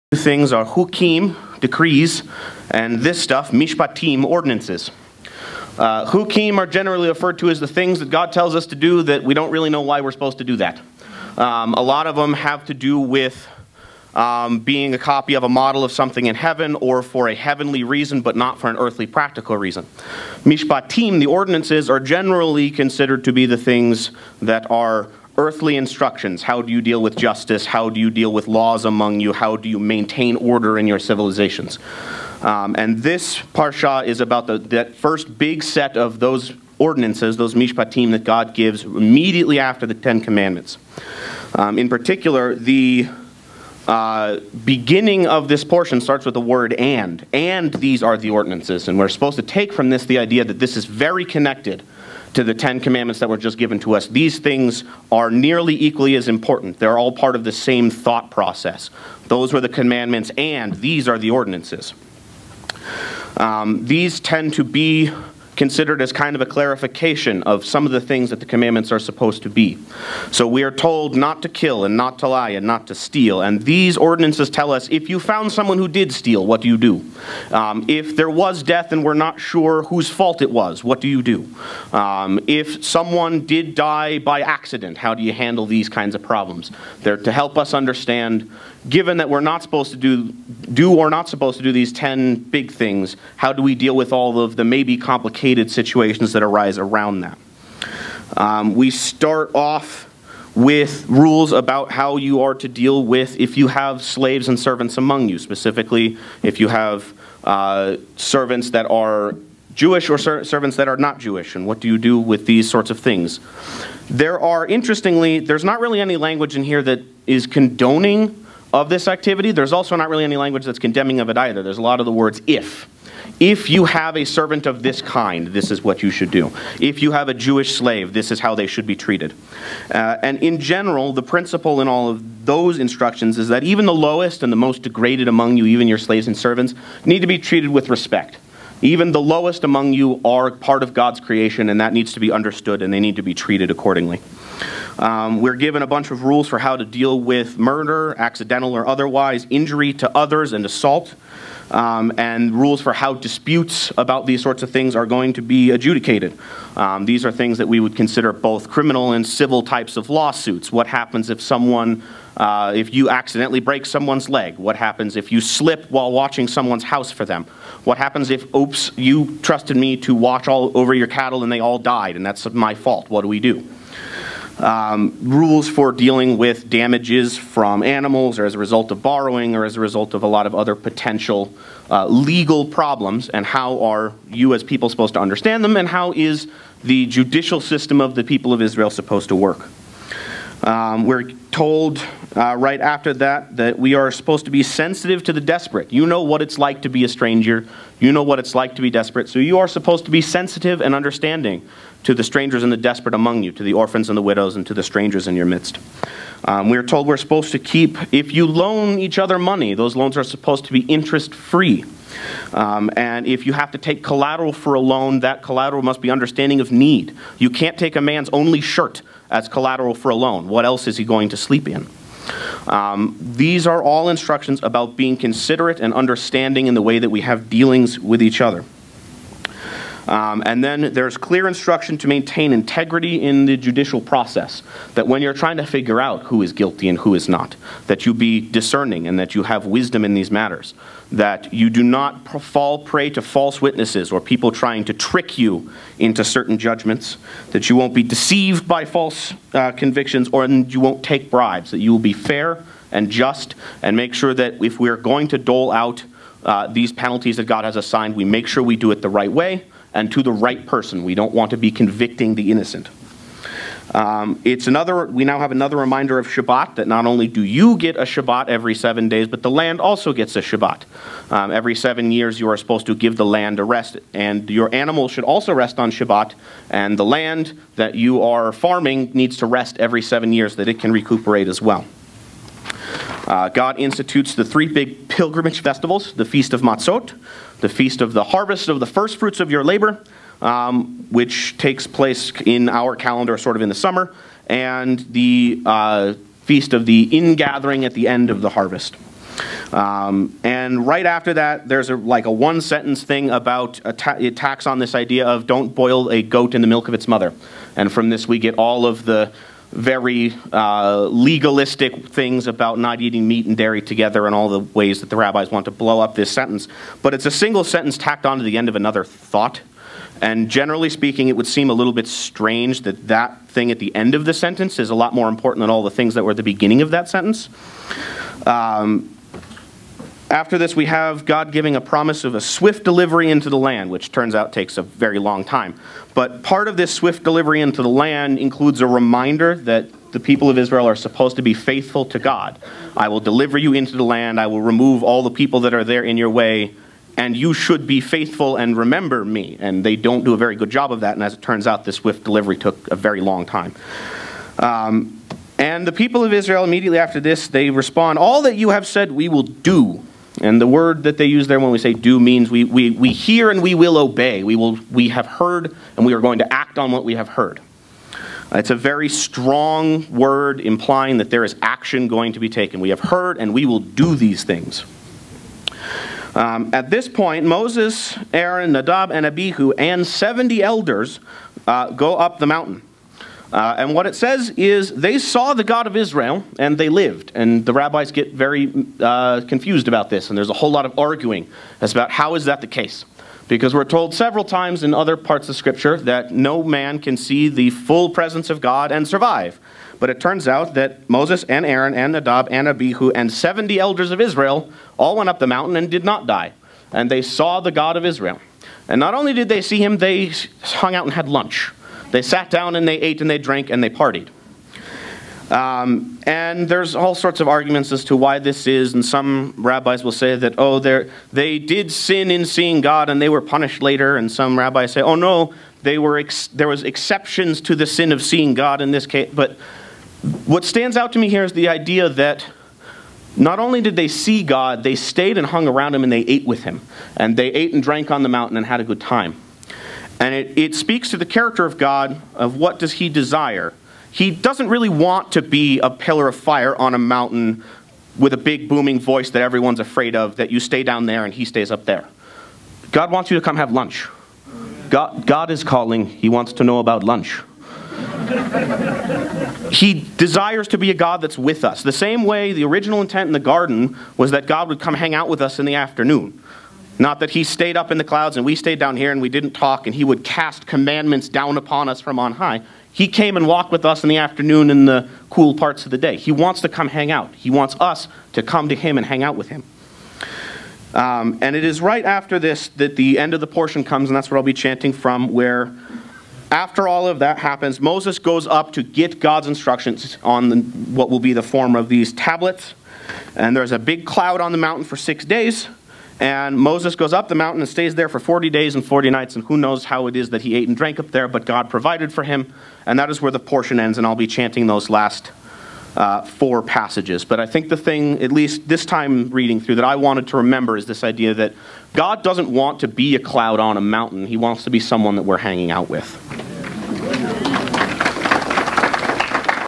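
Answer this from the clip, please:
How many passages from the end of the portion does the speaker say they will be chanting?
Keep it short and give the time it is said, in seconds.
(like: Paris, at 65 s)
4, at 506 s.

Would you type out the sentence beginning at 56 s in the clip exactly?
They're all part of the same thought process.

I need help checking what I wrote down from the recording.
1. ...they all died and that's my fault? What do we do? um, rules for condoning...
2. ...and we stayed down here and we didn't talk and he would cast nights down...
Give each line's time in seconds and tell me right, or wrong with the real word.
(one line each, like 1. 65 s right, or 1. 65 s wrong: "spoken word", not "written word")
1. 171 s wrong: "dealing", not "condoning"
2. 468 s wrong: "commandments", not "nights".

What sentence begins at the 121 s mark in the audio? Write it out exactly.
There's a lot of the words if.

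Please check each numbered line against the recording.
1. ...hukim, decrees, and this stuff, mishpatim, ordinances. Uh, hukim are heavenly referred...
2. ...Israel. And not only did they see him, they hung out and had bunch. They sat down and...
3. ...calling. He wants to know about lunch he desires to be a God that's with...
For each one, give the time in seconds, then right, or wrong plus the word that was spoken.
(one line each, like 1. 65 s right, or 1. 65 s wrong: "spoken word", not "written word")
1. 0 s wrong: "generally", not "heavenly"
2. 408 s wrong: "lunch", not "bunch"
3. 455 s right.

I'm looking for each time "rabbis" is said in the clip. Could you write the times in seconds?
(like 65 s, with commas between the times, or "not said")
315 s, 387 s, 419 s, 424 s.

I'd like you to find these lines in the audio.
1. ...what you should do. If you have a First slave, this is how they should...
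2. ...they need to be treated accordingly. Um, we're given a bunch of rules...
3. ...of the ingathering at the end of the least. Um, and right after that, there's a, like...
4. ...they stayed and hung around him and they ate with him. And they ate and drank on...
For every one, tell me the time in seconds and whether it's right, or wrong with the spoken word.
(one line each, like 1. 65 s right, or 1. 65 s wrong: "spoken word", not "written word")
1. 125 s wrong: "Jewish", not "First"
2. 142 s right
3. 296 s wrong: "harvest", not "least"
4. 434 s right.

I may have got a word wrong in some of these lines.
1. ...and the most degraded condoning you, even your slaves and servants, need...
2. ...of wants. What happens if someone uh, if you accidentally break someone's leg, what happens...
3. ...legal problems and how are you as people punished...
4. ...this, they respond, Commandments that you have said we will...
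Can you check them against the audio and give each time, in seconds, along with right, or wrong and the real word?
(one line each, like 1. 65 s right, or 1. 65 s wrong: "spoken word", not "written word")
1. 134 s wrong: "among", not "condoning"
2. 159 s wrong: "lawsuits", not "wants"
3. 182 s wrong: "supposed", not "punished"
4. 357 s wrong: "All", not "Commandments".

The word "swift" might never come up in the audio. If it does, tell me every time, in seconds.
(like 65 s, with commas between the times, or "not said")
332 s, 336 s, 351 s.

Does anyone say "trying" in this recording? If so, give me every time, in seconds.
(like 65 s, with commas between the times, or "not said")
235 s, 244 s.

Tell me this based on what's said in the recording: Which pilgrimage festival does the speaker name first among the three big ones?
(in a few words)
Feast of Matzot.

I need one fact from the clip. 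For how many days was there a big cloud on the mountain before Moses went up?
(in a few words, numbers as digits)
6.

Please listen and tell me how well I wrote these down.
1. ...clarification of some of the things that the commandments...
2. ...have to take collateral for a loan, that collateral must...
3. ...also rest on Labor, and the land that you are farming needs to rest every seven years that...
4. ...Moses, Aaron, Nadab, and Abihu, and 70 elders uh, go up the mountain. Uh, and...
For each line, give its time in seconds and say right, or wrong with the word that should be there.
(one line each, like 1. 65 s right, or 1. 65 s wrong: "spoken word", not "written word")
1. 66 s right
2. 213 s right
3. 275 s wrong: "Shabbat", not "Labor"
4. 377 s right.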